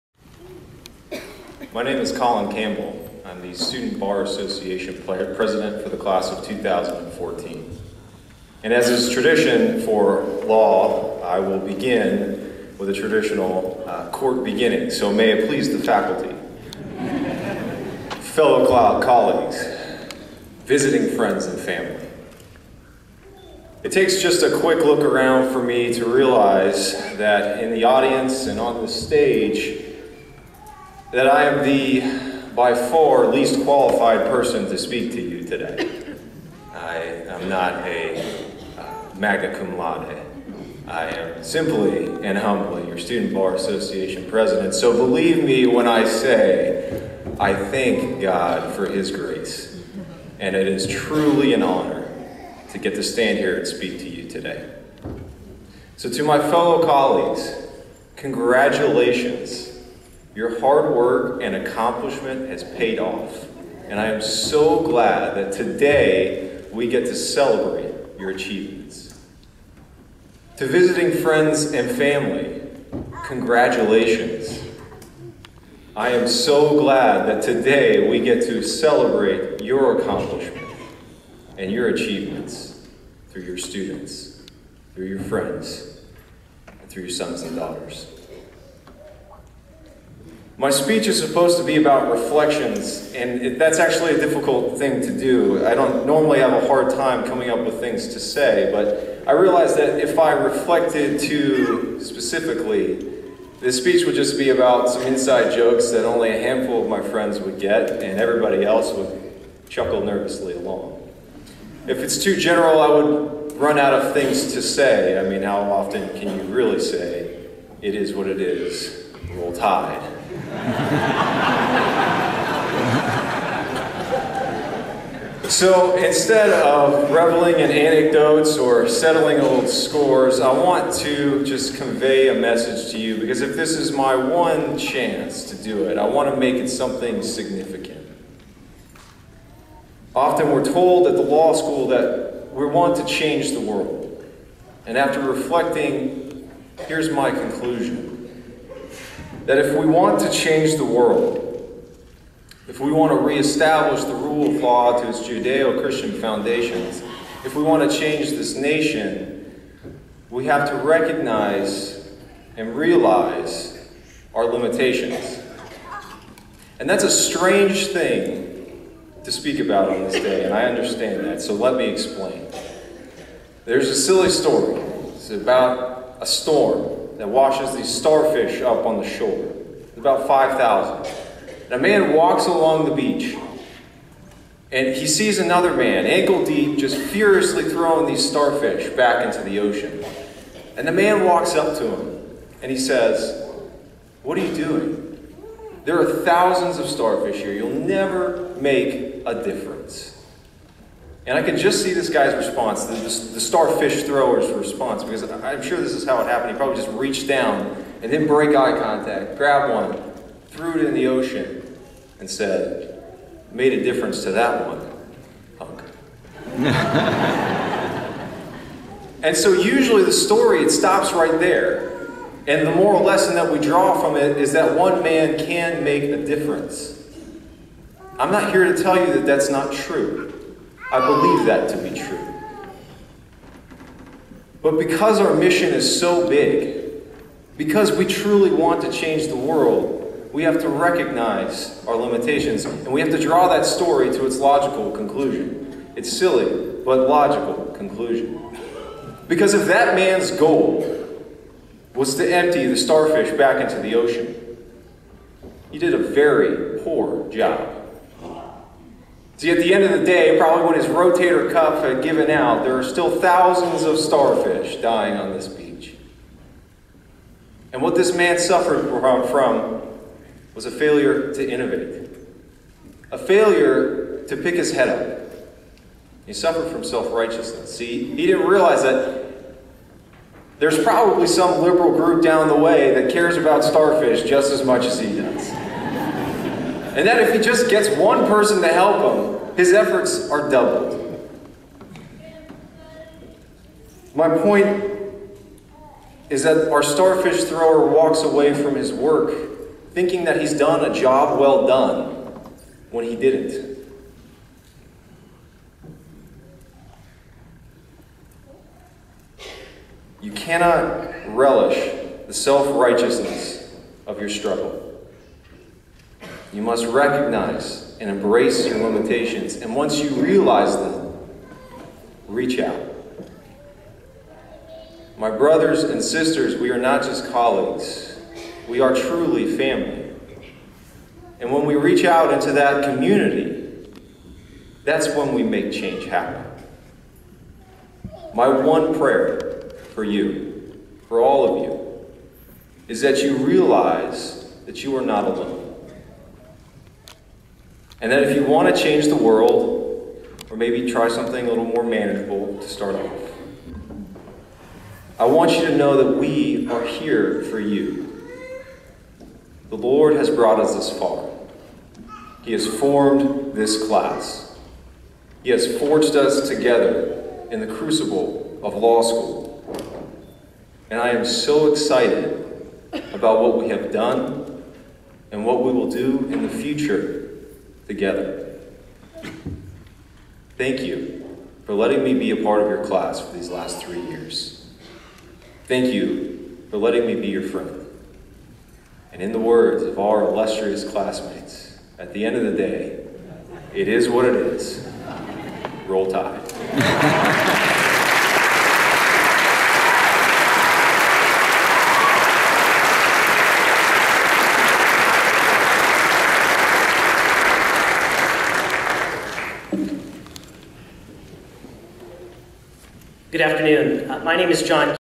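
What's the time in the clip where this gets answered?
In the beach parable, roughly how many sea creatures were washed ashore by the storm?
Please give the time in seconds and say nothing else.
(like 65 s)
180 s.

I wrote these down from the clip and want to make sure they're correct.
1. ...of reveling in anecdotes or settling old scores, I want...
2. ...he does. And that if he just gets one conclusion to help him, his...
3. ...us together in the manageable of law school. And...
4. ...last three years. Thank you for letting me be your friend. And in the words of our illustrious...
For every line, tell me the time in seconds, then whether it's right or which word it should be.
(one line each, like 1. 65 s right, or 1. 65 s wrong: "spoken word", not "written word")
1. 126 s right
2. 284 s wrong: "person", not "conclusion"
3. 366 s wrong: "crucible", not "manageable"
4. 383 s right.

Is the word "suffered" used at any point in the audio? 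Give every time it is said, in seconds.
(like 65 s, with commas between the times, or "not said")
268 s, 276 s.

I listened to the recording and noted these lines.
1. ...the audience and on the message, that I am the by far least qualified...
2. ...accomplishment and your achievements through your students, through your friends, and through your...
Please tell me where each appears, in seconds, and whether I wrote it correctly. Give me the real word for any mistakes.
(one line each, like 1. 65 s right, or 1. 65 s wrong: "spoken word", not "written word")
1. 27 s wrong: "stage", not "message"
2. 79 s right.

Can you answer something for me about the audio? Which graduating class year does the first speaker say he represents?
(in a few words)
2014.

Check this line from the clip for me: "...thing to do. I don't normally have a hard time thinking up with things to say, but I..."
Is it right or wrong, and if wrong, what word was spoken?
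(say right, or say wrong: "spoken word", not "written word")
wrong: "coming", not "thinking".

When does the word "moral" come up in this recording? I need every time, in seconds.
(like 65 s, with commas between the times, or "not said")
222 s.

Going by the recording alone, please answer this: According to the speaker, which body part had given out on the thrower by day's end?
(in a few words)
rotator cuff.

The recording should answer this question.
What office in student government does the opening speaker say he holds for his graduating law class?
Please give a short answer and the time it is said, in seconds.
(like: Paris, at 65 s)
Student Bar Association president, at 42 s.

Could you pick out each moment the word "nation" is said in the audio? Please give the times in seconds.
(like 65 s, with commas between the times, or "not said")
158 s.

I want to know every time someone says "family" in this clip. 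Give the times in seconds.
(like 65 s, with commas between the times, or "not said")
21 s, 71 s, 329 s.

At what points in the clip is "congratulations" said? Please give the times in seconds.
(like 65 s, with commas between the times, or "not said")
58 s, 73 s.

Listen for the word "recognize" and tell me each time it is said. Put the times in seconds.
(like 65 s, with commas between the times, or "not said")
160 s, 240 s, 316 s.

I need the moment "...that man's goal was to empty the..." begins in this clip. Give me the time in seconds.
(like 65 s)
249 s.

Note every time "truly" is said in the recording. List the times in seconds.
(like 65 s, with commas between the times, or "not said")
50 s, 238 s, 328 s.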